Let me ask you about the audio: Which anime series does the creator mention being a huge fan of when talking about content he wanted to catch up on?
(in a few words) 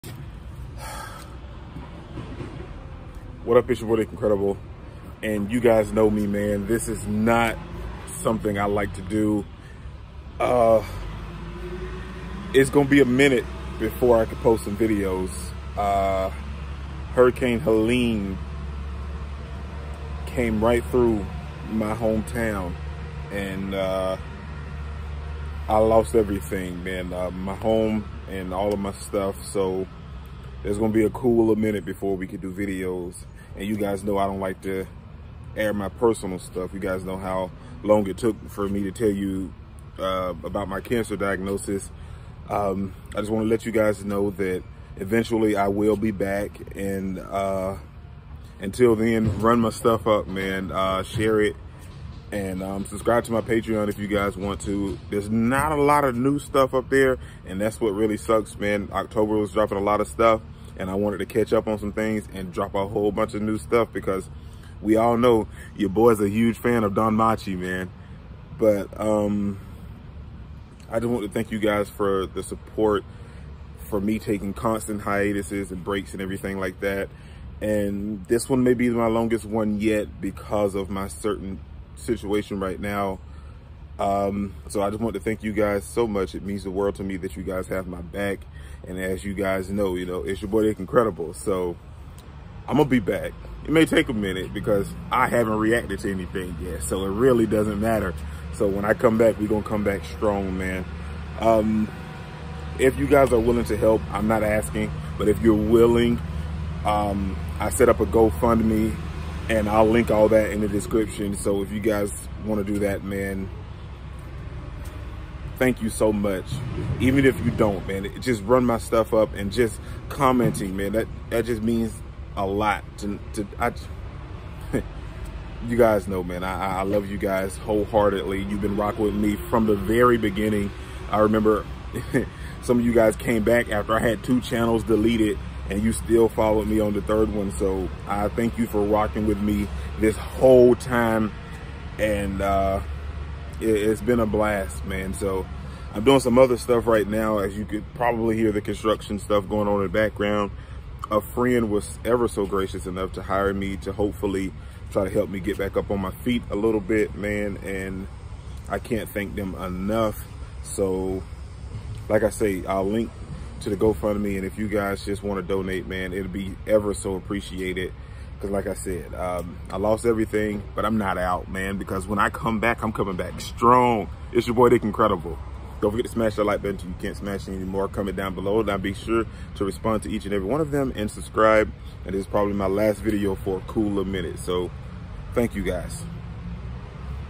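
DanMachi.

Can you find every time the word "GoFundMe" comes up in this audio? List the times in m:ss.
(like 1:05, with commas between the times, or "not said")
1:48, 2:43.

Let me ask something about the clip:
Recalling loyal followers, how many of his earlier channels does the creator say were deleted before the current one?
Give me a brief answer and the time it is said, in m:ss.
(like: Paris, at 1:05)
2, at 2:14.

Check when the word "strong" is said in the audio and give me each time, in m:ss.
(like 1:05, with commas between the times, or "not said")
1:40, 2:53.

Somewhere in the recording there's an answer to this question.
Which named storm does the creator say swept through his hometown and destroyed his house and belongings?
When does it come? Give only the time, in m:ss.
0:17.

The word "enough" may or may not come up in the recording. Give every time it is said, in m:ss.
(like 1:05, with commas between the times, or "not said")
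2:32, 2:39.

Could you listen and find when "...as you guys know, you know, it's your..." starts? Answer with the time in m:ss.
1:28.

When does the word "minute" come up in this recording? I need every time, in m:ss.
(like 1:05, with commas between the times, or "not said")
0:13, 0:31, 1:34, 3:04.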